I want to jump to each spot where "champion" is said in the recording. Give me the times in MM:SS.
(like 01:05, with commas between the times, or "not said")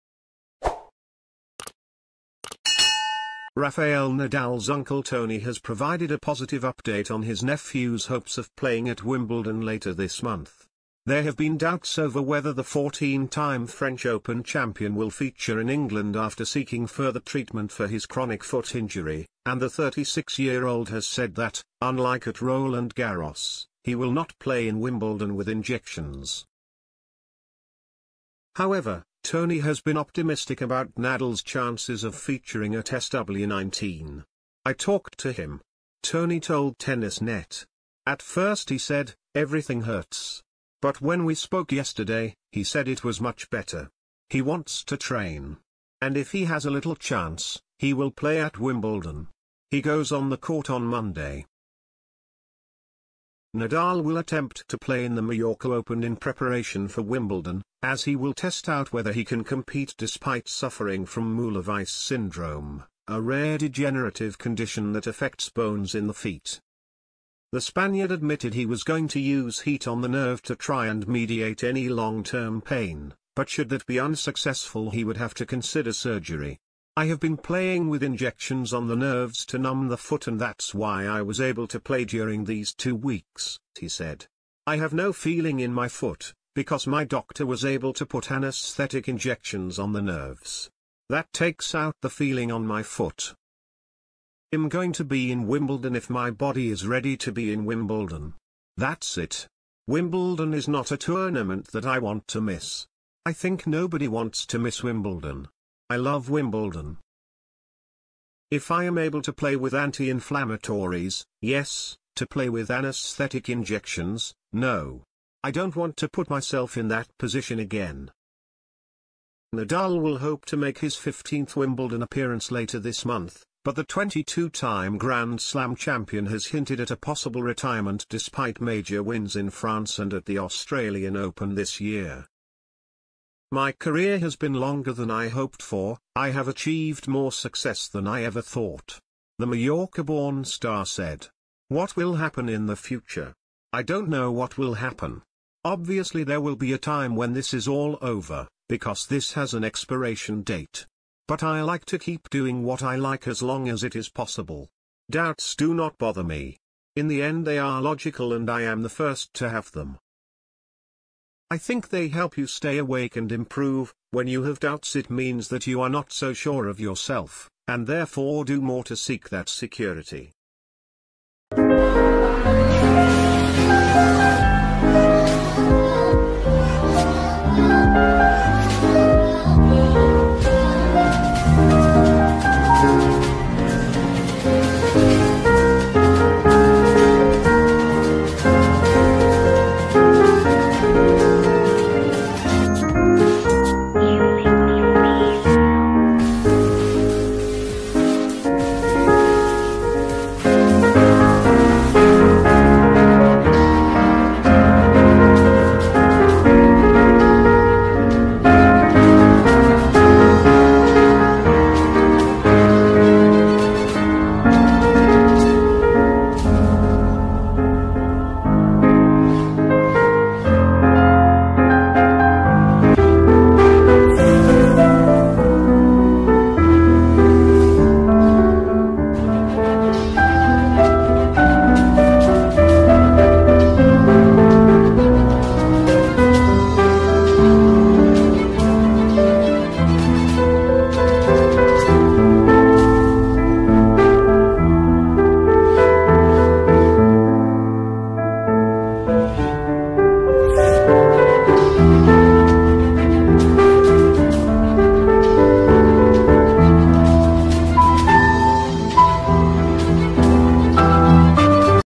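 00:14, 02:05.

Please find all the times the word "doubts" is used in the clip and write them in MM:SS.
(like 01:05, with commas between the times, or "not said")
00:11, 02:35, 02:44.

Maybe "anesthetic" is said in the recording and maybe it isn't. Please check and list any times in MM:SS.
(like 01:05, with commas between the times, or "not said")
01:28, 01:52.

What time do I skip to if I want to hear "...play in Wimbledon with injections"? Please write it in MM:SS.
00:24.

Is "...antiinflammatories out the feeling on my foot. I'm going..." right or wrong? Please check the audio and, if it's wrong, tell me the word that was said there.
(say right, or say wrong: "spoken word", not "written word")
wrong: "takes", not "antiinflammatories".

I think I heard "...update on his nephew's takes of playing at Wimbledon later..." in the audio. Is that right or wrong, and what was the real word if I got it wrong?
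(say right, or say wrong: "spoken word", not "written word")
wrong: "hopes", not "takes".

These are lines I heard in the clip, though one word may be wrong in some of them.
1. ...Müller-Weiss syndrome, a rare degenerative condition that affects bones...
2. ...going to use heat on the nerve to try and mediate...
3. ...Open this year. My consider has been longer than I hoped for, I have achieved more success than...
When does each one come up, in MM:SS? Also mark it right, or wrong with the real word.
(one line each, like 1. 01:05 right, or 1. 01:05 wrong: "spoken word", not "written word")
1. 01:01 right
2. 01:08 right
3. 02:11 wrong: "career", not "consider".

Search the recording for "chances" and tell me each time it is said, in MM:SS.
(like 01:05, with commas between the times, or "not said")
00:31, 00:46.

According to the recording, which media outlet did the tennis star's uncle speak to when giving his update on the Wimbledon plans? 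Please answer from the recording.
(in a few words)
Tennis Net.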